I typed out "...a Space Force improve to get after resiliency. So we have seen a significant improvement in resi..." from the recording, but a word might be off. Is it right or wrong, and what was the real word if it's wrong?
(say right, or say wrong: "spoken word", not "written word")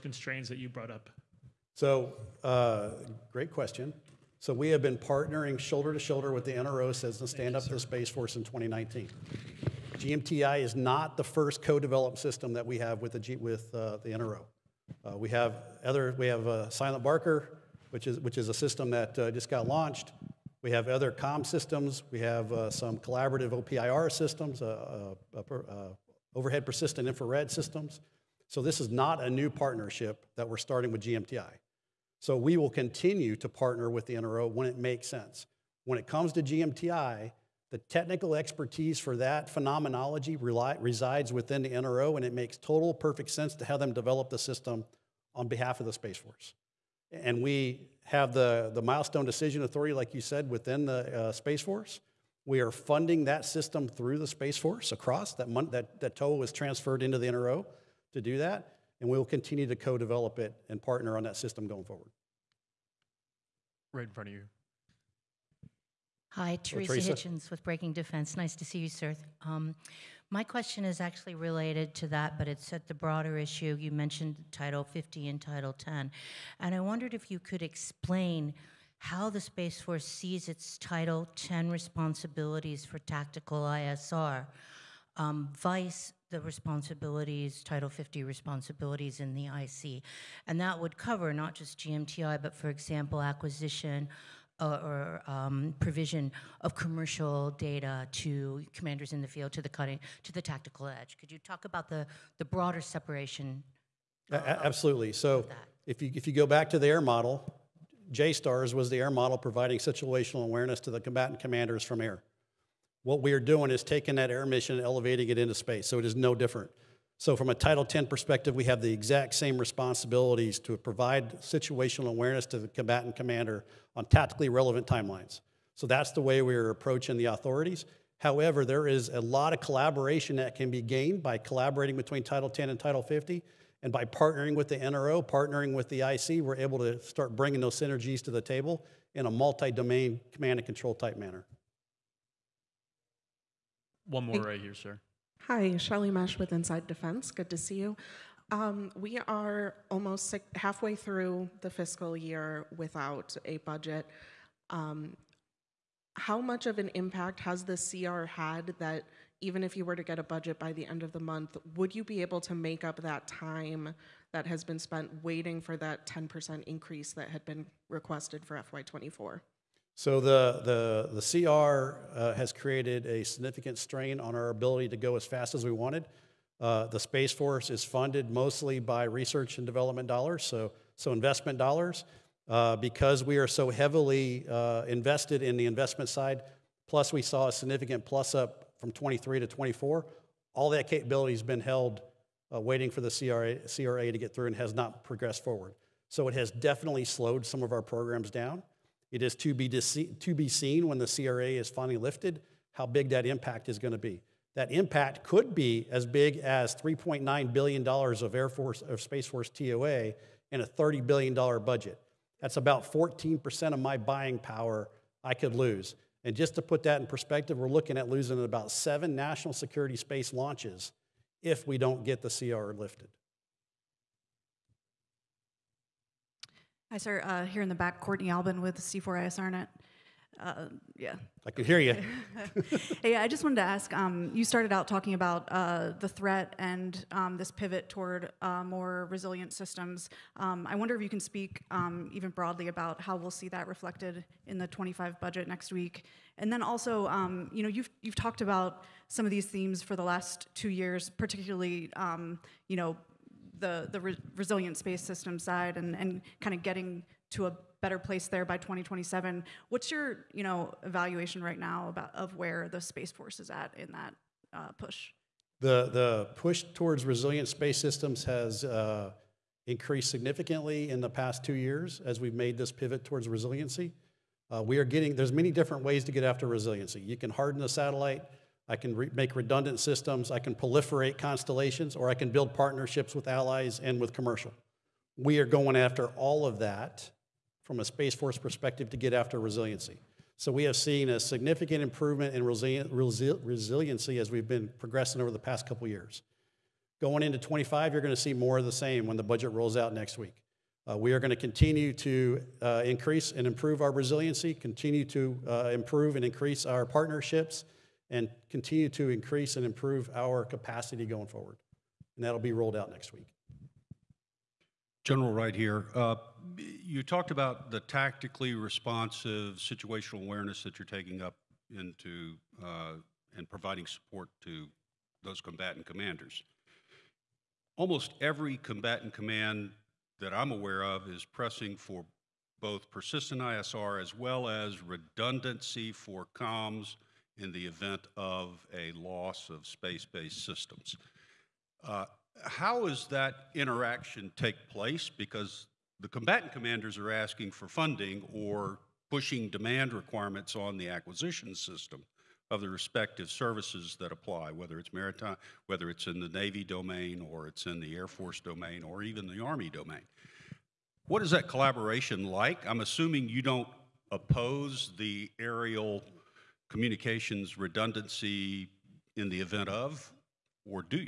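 wrong: "perspective", not "improve".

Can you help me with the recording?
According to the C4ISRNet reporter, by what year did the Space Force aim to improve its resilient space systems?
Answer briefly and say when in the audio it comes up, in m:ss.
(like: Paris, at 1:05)
2027, at 4:18.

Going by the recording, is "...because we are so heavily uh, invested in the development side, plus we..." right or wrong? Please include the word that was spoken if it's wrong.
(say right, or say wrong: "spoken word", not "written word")
wrong: "investment", not "development".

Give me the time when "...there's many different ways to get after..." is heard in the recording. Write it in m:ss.
4:35.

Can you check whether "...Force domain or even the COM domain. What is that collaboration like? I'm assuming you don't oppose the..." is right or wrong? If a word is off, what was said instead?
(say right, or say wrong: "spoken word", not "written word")
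wrong: "Army", not "COM".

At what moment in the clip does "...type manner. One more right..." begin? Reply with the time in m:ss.
2:20.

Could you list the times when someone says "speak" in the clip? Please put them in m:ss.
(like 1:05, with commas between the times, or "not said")
4:01.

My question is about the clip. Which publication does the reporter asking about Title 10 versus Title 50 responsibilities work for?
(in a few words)
Breaking Defense.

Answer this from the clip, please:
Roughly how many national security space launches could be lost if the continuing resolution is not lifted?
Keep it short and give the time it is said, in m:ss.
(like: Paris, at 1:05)
7, at 3:38.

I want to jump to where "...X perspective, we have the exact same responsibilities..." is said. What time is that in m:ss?
1:57.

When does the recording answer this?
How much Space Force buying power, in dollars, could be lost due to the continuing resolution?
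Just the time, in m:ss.
3:26.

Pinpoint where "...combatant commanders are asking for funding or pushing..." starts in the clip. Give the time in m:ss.
5:46.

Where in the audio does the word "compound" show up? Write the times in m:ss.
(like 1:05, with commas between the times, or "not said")
not said.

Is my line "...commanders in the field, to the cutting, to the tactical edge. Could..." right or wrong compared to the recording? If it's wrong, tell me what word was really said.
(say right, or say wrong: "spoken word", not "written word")
right.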